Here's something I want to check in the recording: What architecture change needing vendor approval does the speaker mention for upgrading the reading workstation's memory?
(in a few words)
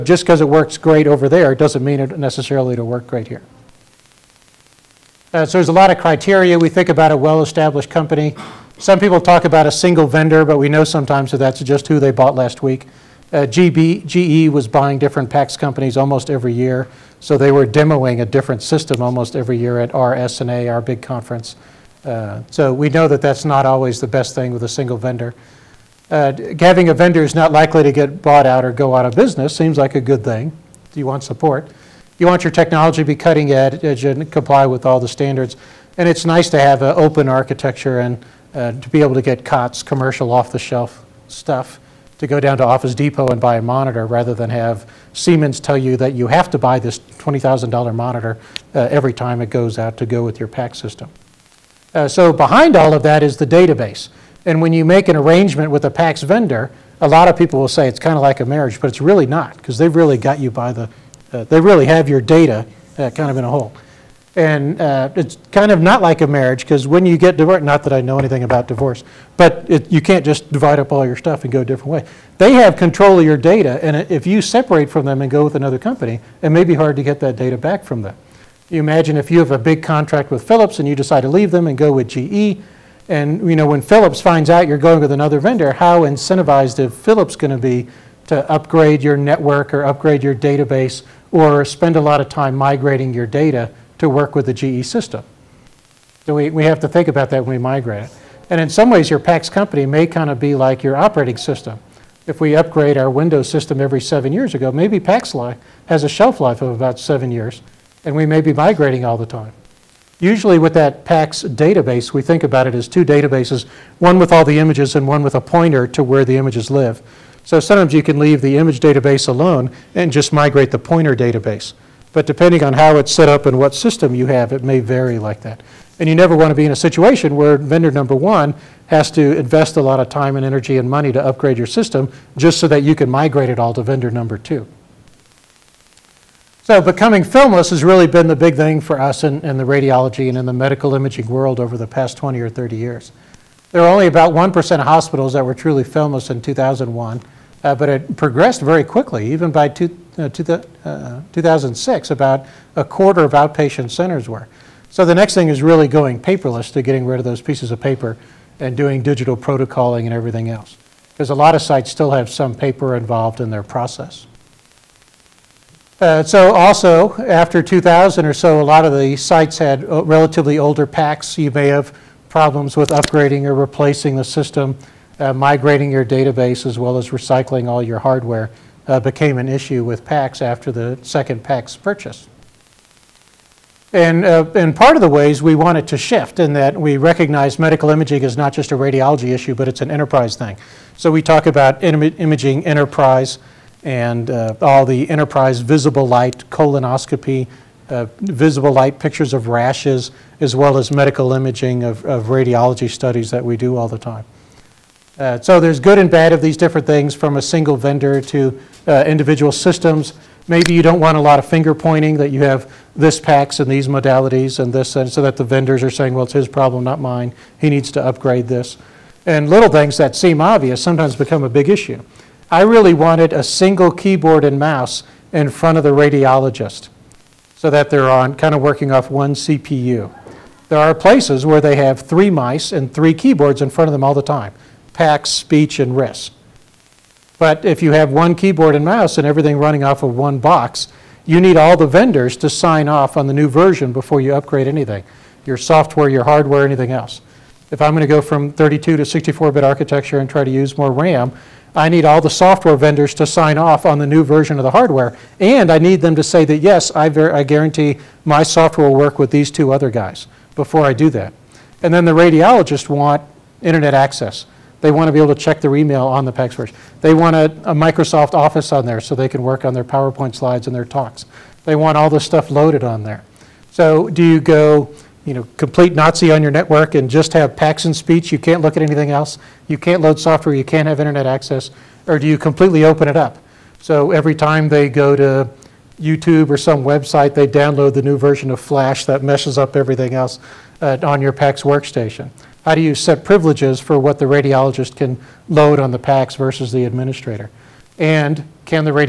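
32 to 64-bit.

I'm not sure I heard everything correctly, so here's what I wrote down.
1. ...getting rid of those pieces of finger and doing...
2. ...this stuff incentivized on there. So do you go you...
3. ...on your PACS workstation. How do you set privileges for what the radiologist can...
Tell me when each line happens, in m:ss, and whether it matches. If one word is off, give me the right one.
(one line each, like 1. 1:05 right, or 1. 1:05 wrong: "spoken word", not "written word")
1. 2:36 wrong: "paper", not "finger"
2. 4:32 wrong: "loaded", not "incentivized"
3. 4:51 right.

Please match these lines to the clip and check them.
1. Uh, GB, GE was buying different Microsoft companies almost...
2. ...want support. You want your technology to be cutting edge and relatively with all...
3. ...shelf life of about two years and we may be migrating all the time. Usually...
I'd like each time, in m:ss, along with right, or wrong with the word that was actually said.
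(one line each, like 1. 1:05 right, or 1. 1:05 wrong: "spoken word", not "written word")
1. 0:13 wrong: "PACS", not "Microsoft"
2. 0:31 wrong: "comply", not "relatively"
3. 1:46 wrong: "seven", not "two".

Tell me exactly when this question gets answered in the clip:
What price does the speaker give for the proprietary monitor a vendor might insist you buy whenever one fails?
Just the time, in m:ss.
0:46.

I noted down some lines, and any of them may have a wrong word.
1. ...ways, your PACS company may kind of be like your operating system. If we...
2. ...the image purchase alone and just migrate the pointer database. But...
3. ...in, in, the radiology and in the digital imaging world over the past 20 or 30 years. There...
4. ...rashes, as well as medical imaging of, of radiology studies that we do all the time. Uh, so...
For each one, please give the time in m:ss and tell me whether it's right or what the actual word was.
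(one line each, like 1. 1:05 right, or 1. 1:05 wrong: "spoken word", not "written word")
1. 1:38 right
2. 1:58 wrong: "database", not "purchase"
3. 2:19 wrong: "medical", not "digital"
4. 3:19 right.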